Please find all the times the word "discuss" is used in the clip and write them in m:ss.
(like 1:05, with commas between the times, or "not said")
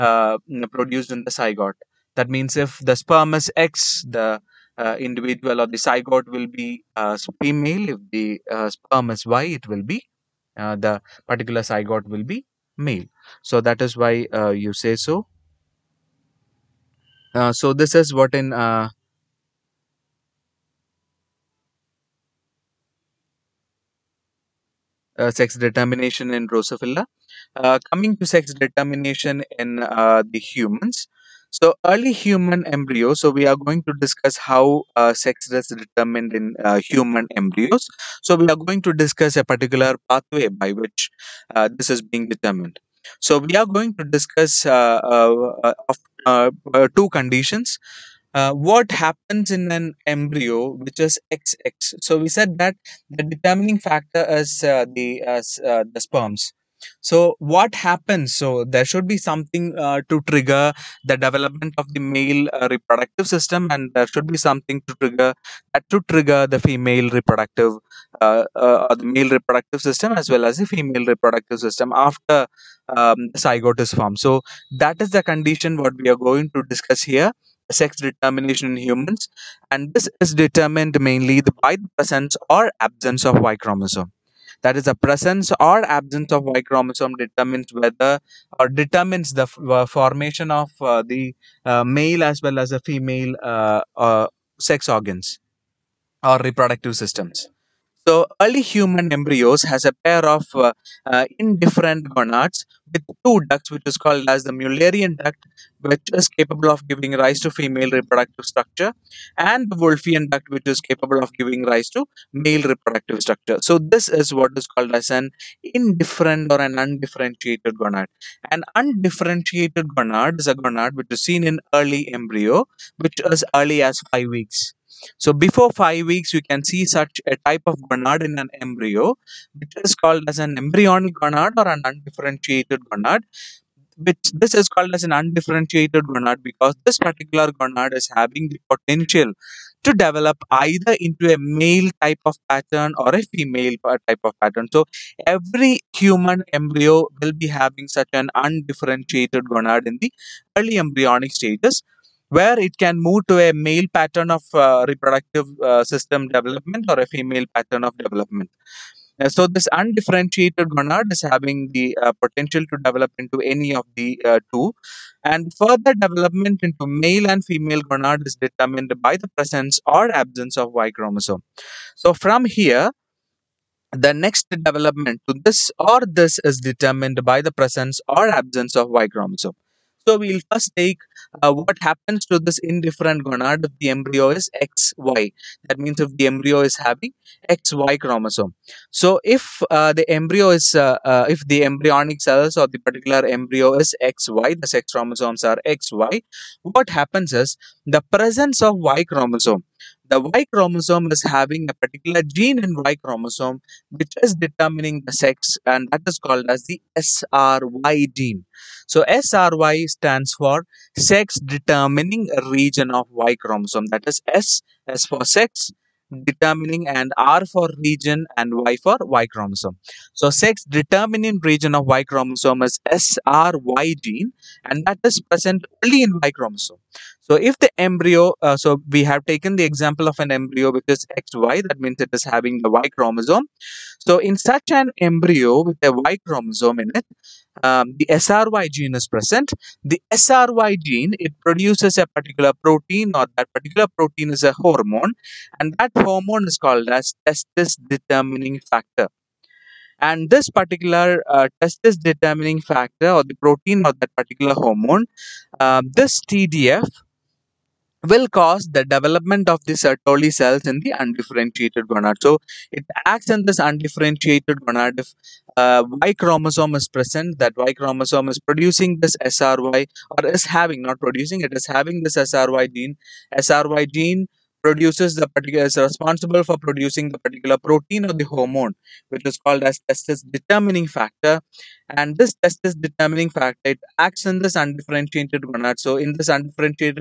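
0:33, 0:38, 0:44, 1:16.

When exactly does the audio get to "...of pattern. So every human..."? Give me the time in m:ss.
2:24.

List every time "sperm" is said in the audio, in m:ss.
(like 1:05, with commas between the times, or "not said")
0:02, 0:08, 0:56.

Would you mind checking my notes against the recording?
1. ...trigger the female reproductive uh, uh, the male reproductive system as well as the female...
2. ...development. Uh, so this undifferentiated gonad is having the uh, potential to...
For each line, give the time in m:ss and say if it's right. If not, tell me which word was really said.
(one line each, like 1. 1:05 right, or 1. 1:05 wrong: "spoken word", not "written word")
1. 1:06 right
2. 2:37 right.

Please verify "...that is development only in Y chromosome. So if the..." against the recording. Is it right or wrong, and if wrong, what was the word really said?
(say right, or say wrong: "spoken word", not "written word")
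wrong: "present", not "development".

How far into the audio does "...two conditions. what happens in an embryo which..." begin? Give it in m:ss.
0:46.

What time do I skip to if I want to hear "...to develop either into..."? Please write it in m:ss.
2:19.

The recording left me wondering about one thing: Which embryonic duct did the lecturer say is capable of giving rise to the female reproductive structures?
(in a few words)
Mullerian duct.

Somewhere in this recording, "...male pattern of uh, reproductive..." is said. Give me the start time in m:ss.
2:33.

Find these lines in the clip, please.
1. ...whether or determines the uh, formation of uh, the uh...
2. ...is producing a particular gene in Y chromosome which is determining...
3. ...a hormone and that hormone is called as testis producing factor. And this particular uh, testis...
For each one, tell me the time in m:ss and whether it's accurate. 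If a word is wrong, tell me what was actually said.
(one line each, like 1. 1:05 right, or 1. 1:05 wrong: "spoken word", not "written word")
1. 1:27 right
2. 3:21 wrong: "having", not "producing"
3. 4:04 wrong: "determining", not "producing".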